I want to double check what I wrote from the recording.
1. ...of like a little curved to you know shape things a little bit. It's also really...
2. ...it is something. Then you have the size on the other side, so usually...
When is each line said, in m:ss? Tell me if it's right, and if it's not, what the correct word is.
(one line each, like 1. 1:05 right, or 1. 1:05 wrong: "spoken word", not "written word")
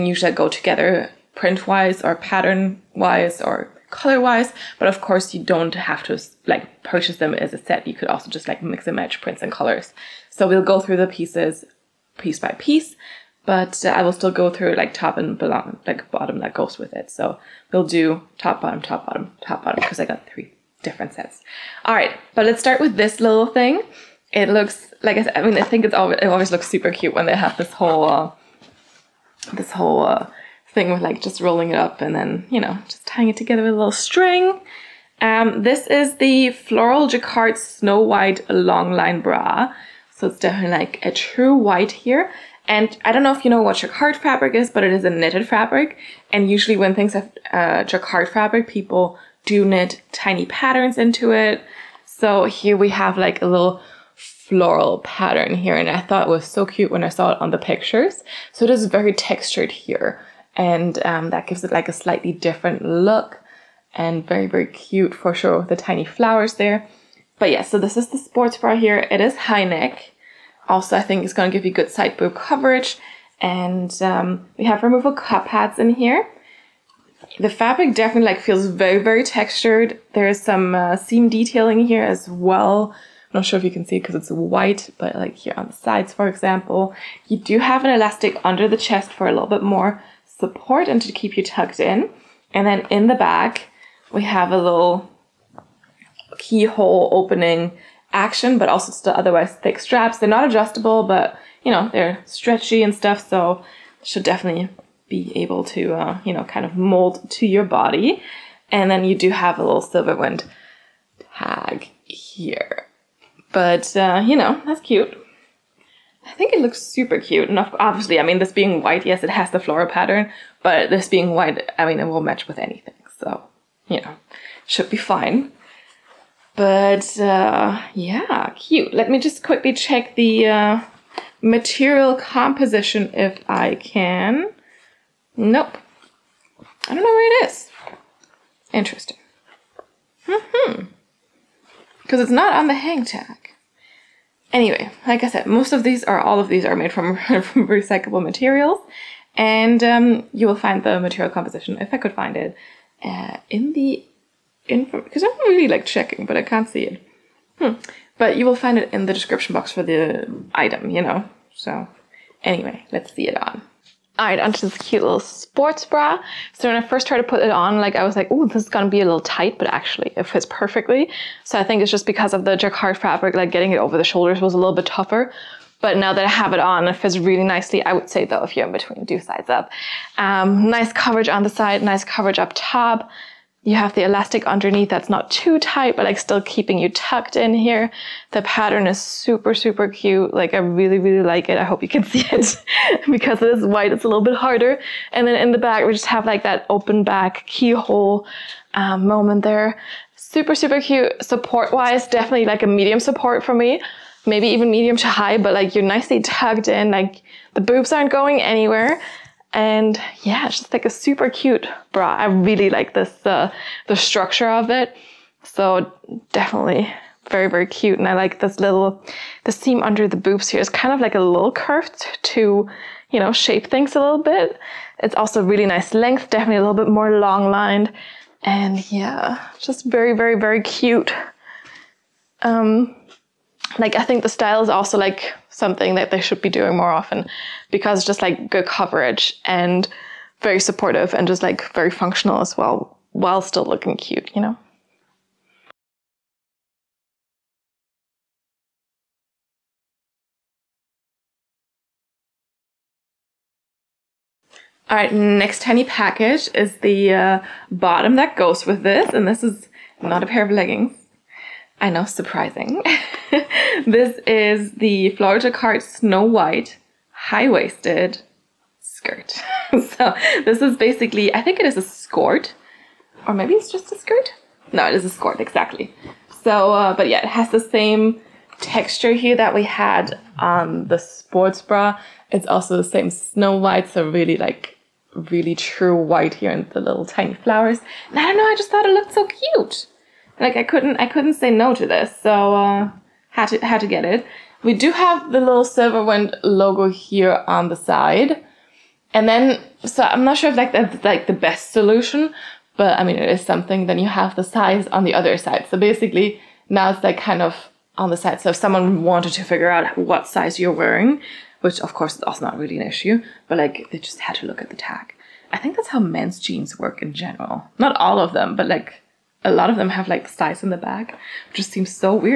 1. 3:40 right
2. 5:03 wrong: "basically", not "usually".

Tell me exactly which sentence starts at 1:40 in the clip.
They're not adjustable, but you know, they're stretchy and stuff.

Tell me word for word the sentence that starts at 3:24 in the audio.
Maybe even medium to high, but like you're nicely tucked in.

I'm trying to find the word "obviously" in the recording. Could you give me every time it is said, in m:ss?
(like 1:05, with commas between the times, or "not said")
1:57.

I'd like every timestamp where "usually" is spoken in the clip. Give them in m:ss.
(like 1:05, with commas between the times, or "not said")
0:00, 0:46.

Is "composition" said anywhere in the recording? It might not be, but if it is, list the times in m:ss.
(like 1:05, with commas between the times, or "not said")
2:12, 2:31.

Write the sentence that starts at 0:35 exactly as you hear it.
Um, this is the Floral Jacquard Snow White Long Line Bra.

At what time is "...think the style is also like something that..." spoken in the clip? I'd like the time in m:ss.
3:54.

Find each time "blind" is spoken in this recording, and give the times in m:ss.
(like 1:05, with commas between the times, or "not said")
not said.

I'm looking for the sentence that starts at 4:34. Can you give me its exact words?
No, it is a skirt, exactly.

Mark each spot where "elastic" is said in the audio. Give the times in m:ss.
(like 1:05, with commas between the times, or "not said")
1:27, 3:04.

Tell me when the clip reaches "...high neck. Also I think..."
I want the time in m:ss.
1:09.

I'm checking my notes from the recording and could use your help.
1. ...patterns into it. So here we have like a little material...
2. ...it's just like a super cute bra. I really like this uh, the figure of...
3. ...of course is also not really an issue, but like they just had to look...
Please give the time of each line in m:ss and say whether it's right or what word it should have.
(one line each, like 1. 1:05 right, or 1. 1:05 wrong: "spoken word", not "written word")
1. 0:50 wrong: "floral", not "material"
2. 3:30 wrong: "structure", not "figure"
3. 5:11 right.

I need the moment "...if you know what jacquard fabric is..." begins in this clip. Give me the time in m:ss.
0:43.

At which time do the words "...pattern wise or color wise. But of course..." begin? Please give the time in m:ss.
0:02.